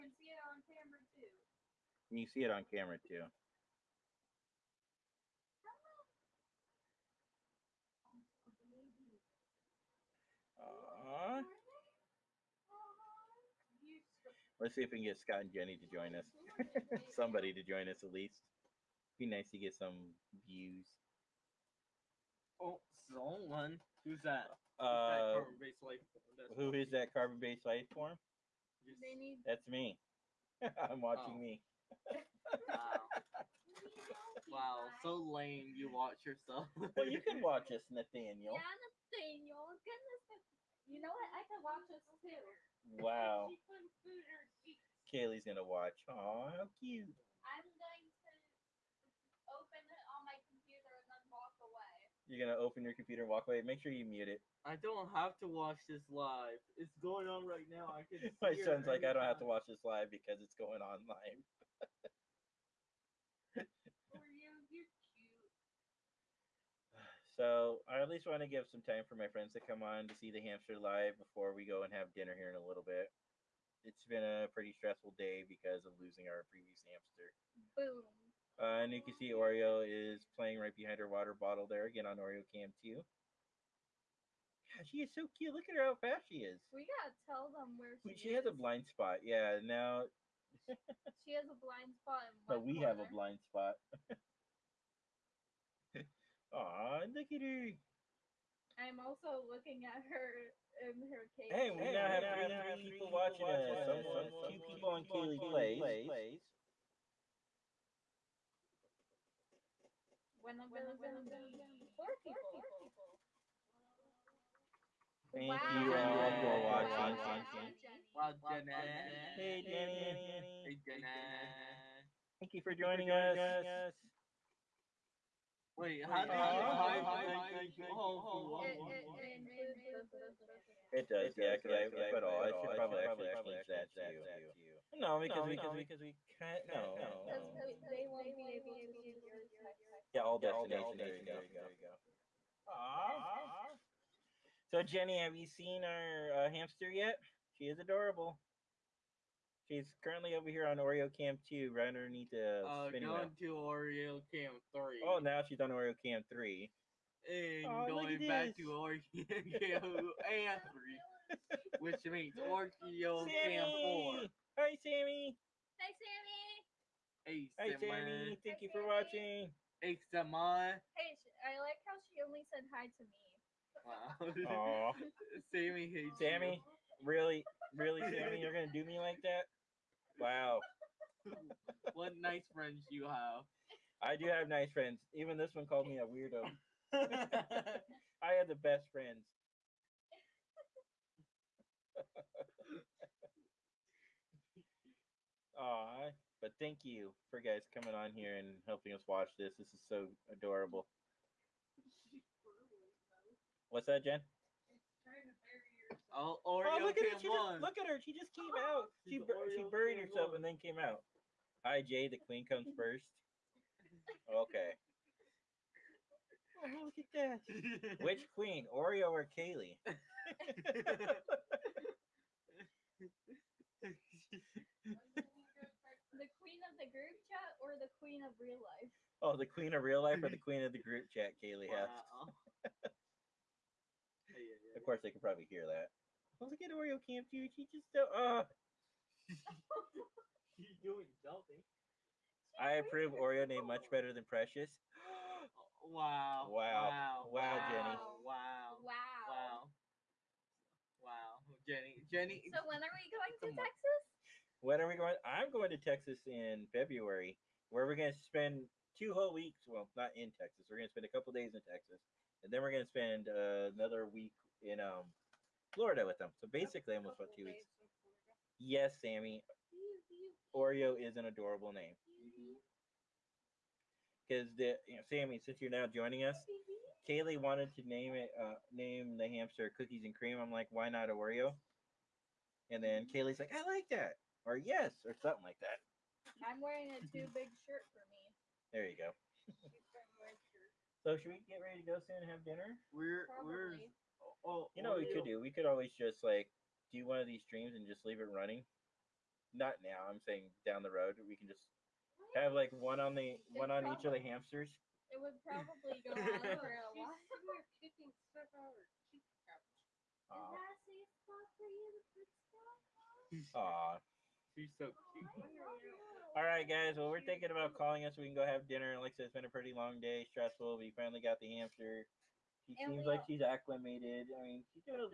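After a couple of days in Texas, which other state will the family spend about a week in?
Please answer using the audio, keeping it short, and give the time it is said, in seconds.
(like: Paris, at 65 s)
Florida, at 265 s.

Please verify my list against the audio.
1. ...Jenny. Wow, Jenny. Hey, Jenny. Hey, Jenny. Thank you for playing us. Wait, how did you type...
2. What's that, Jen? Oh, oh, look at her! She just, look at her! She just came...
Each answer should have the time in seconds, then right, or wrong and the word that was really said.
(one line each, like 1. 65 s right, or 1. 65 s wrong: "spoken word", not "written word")
1. 117 s wrong: "joining", not "playing"
2. 203 s right.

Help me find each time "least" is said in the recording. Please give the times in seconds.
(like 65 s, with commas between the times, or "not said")
18 s, 68 s.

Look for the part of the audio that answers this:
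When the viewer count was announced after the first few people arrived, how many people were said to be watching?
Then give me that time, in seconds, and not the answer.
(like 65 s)
111 s.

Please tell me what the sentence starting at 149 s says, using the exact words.
She's currently over here on Oreo Cam 2, right underneath the uh, going to Oreo Cam 3.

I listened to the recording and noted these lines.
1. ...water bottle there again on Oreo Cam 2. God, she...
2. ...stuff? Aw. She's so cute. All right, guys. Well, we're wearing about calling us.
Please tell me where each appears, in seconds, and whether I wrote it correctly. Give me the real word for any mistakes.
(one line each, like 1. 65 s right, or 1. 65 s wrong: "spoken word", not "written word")
1. 81 s right
2. 312 s wrong: "thinking", not "wearing".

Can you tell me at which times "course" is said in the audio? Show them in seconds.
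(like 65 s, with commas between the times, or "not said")
234 s.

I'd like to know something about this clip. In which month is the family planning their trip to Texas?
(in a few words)
February.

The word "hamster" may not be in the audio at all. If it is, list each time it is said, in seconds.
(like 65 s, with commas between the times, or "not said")
70 s, 76 s, 146 s, 279 s, 304 s, 321 s.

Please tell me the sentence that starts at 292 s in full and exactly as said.
We're we're oh, oh you know what we oh, could oh.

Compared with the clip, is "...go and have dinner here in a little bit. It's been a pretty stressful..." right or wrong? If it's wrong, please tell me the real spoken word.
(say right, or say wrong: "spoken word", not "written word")
right.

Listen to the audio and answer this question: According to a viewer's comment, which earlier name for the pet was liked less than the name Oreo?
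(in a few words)
Precious.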